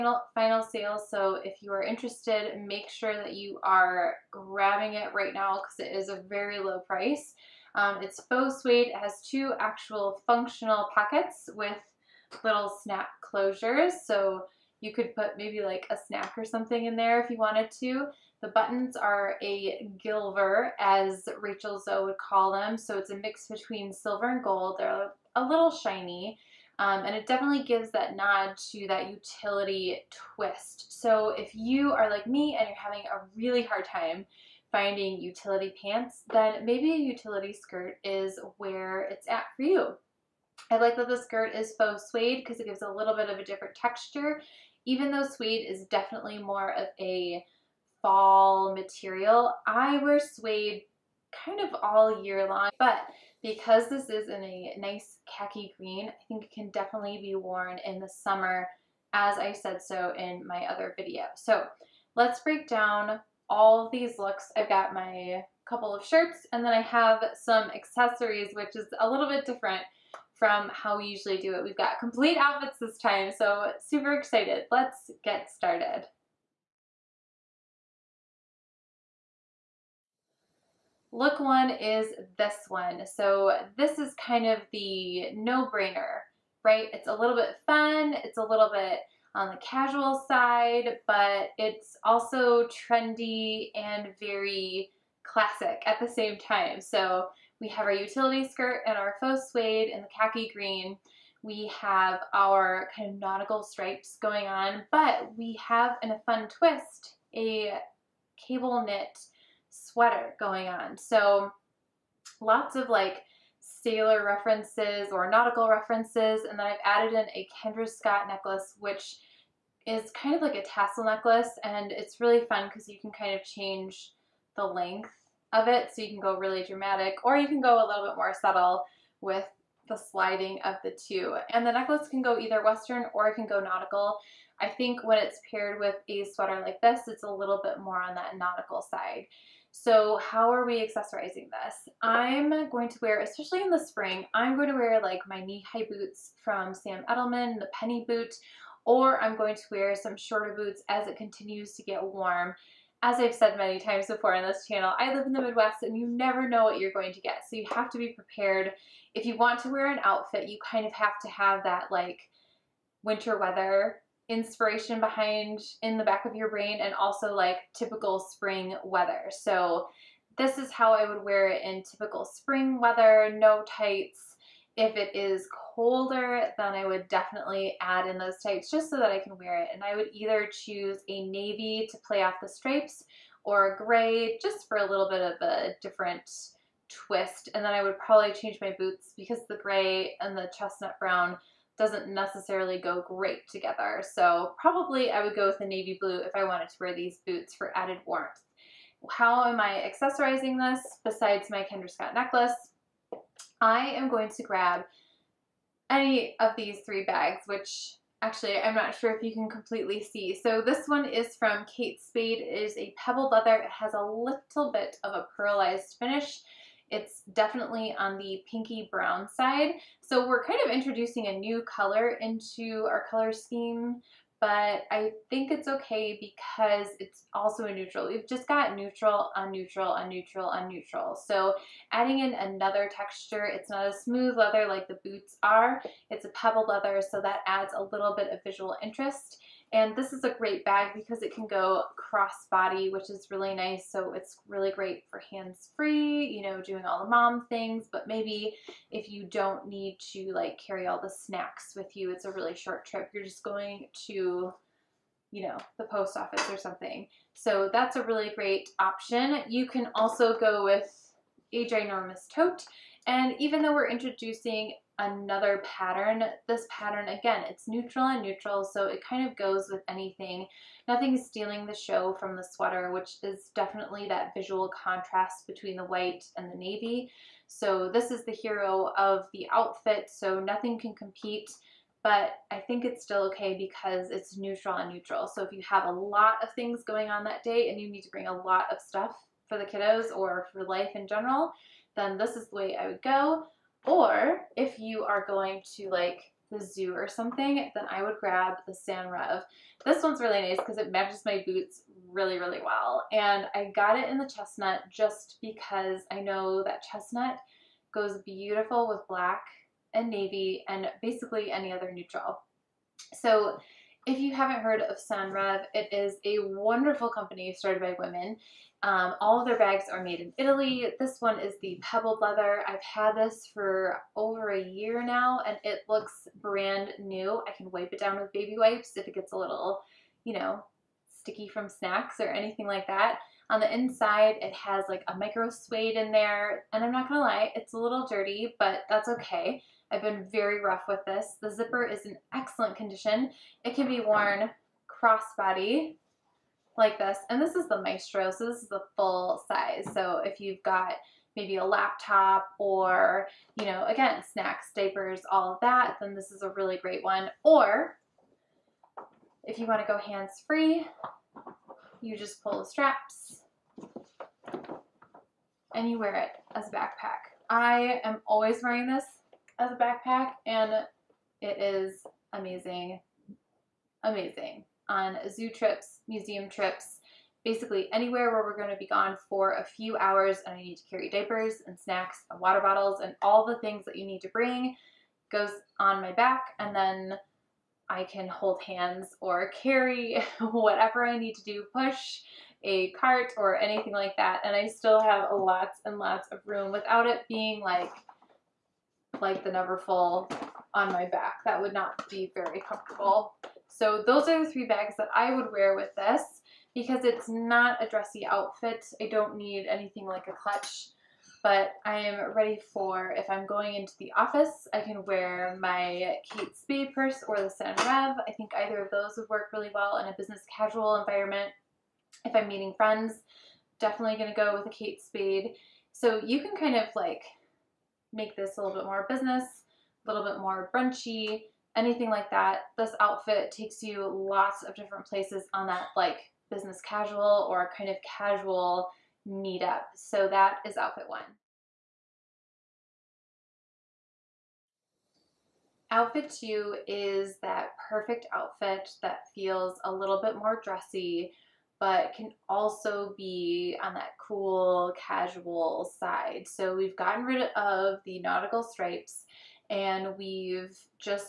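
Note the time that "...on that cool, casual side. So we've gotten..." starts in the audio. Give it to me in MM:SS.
07:33.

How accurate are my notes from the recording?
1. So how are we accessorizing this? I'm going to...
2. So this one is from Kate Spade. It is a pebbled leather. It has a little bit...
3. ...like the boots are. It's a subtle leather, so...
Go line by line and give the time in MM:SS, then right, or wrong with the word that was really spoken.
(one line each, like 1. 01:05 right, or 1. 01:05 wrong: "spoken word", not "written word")
1. 02:19 right
2. 03:30 right
3. 03:54 wrong: "pebble", not "subtle".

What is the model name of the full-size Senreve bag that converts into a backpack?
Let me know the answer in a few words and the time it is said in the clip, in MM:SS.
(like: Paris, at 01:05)
Maestro, at 05:47.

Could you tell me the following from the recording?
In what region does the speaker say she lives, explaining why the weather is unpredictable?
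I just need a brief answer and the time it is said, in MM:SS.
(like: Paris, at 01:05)
the Midwest, at 02:35.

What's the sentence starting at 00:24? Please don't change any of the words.
They're a little shiny, um, and it definitely gives that nod to that utility twist.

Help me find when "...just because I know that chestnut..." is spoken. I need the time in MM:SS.
05:04.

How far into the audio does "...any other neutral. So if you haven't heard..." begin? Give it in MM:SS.
05:11.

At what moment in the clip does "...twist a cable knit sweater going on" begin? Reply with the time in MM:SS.
01:46.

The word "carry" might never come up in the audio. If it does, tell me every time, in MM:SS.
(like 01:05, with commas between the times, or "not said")
04:10, 06:20, 06:29.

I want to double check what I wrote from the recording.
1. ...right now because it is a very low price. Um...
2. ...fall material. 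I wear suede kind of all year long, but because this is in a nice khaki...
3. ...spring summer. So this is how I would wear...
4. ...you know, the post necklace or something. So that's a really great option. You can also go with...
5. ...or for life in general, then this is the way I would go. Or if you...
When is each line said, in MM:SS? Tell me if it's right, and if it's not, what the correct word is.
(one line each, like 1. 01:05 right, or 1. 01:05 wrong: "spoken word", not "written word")
1. 00:05 right
2. 00:48 right
3. 02:48 wrong: "weather", not "summer"
4. 04:15 wrong: "office", not "necklace"
5. 04:50 right.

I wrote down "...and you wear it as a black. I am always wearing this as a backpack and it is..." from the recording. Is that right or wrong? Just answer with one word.
wrong.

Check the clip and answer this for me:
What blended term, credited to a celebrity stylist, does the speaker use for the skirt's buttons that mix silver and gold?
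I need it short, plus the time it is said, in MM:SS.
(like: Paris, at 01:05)
gilver, at 00:20.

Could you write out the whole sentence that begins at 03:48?
We've just got neutral, on neutral, on neutral, on neutral.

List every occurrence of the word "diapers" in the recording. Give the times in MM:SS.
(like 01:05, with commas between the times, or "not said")
05:54, 06:21.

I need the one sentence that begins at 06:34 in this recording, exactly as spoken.
And I still have lots and lots of room without it being like like the Neverfull on my back.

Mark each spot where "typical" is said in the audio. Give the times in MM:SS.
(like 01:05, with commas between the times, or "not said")
02:47, 02:51.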